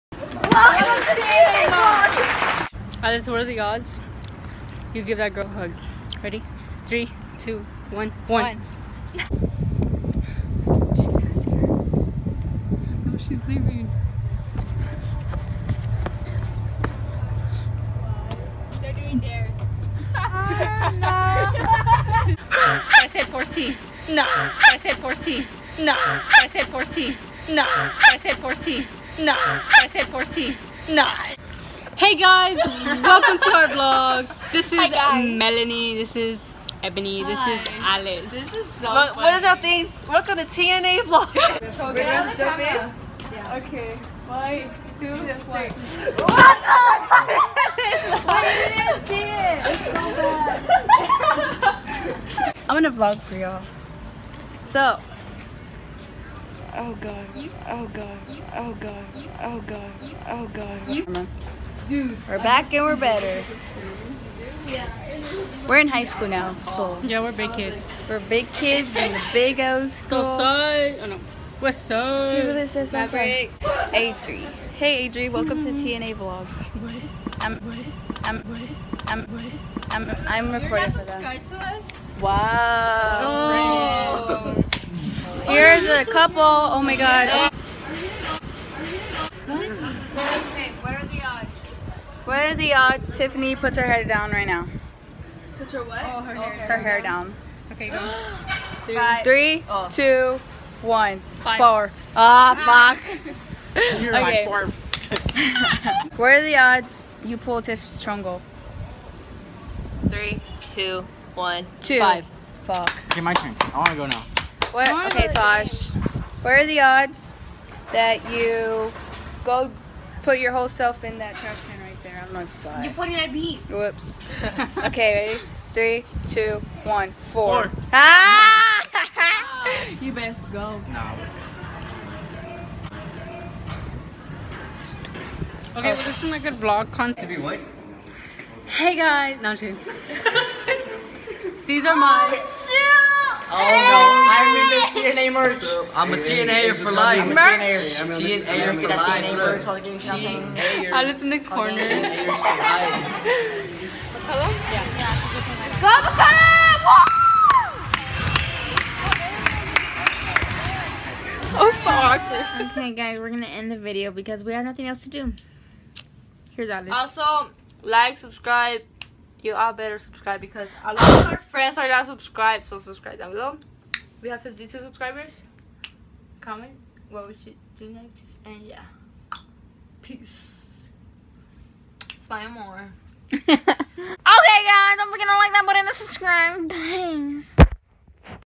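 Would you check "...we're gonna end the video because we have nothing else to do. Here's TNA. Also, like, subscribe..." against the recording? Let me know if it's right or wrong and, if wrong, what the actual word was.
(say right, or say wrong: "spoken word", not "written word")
wrong: "Alice", not "TNA".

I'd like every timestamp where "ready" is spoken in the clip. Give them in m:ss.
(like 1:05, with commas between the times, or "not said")
0:06, 2:05.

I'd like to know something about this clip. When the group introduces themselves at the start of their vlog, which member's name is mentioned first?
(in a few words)
Melanie.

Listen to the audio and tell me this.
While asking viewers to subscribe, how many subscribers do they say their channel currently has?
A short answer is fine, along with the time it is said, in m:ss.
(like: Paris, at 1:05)
52, at 2:54.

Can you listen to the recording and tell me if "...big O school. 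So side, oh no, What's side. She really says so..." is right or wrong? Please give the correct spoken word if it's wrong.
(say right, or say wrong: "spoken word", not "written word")
right.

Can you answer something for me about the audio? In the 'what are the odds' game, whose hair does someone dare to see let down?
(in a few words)
Tiffani.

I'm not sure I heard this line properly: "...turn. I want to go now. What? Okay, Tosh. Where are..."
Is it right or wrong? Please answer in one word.
right.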